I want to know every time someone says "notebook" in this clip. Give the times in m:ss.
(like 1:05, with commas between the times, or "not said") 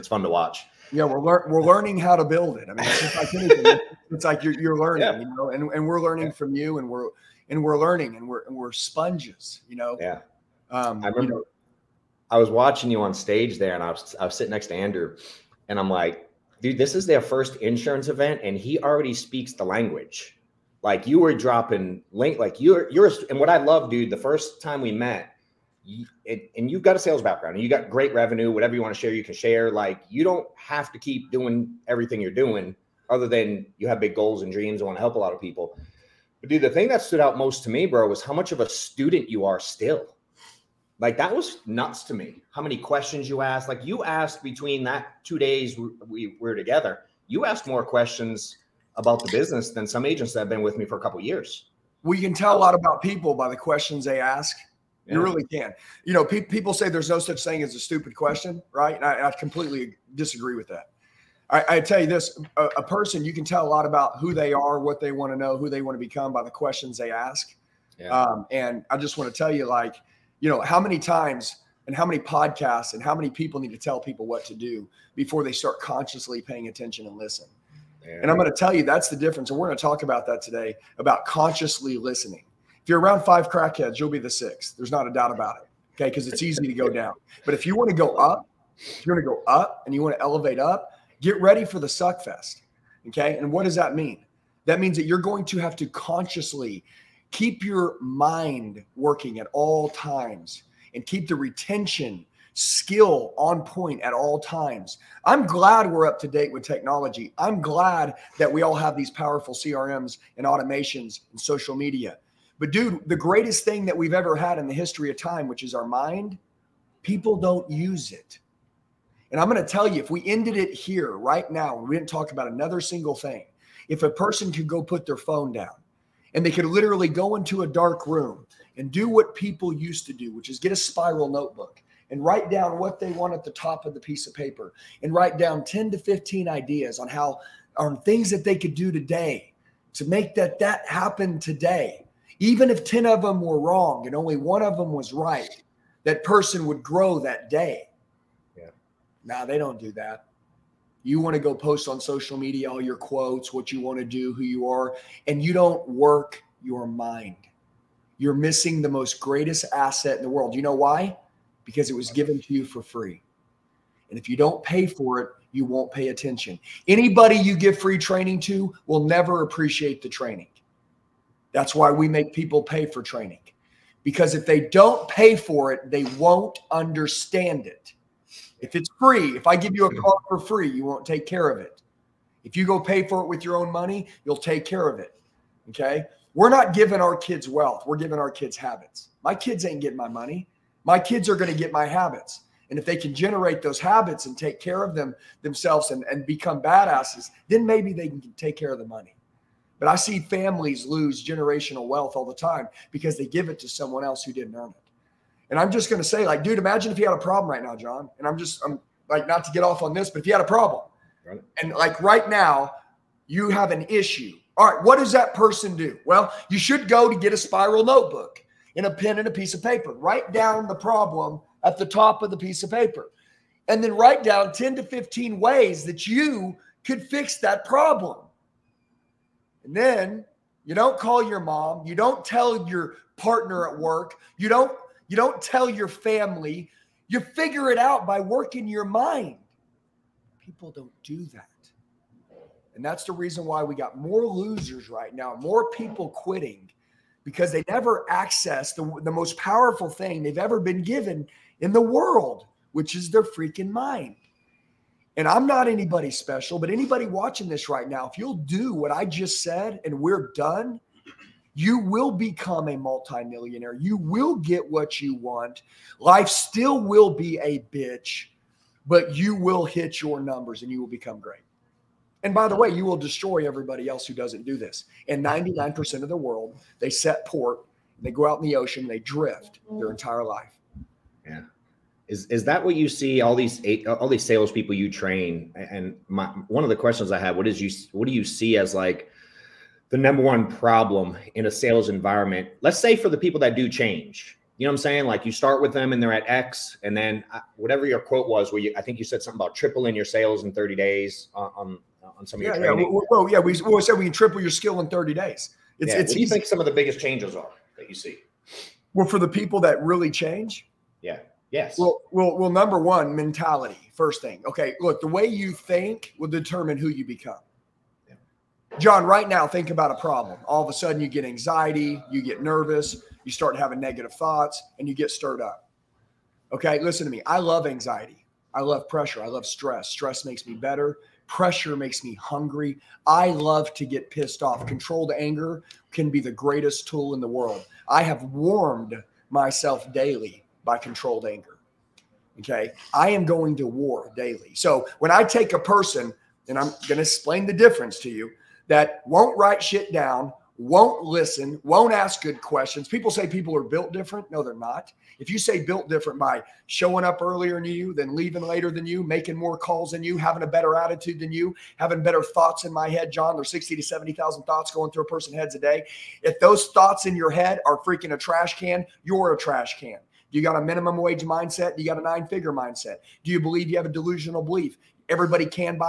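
2:11, 3:37.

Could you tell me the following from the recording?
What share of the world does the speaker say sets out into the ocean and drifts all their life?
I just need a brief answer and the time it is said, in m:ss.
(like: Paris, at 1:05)
99%, at 4:35.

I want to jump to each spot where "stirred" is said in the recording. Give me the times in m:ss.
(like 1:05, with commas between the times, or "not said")
5:25.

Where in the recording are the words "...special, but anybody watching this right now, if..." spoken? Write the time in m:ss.
4:16.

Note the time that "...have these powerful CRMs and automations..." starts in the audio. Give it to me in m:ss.
1:48.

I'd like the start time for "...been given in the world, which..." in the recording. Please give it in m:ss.
4:10.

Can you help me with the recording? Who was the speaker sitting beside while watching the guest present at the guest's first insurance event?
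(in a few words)
Andrew.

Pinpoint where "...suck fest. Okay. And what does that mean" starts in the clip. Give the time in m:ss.
1:31.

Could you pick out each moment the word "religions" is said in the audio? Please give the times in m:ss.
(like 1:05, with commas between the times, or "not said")
not said.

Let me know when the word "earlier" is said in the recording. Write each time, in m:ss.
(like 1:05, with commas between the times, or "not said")
5:57.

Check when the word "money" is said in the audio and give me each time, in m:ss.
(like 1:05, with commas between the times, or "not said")
3:03, 3:10, 3:18.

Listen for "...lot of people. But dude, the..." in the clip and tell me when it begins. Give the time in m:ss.
0:35.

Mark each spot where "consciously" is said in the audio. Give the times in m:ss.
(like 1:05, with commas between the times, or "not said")
1:15, 1:21, 1:35.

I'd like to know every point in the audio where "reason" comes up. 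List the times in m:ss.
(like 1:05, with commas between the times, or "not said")
4:03.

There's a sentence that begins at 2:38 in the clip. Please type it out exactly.
You're missing the most greatest asset in the world.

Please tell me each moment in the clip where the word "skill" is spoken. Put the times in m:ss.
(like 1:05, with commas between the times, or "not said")
1:42, 5:04.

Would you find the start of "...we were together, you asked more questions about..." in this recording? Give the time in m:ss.
0:46.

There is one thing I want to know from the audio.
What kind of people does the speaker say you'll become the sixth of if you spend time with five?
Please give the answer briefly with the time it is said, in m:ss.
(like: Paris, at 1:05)
crackheads, at 1:23.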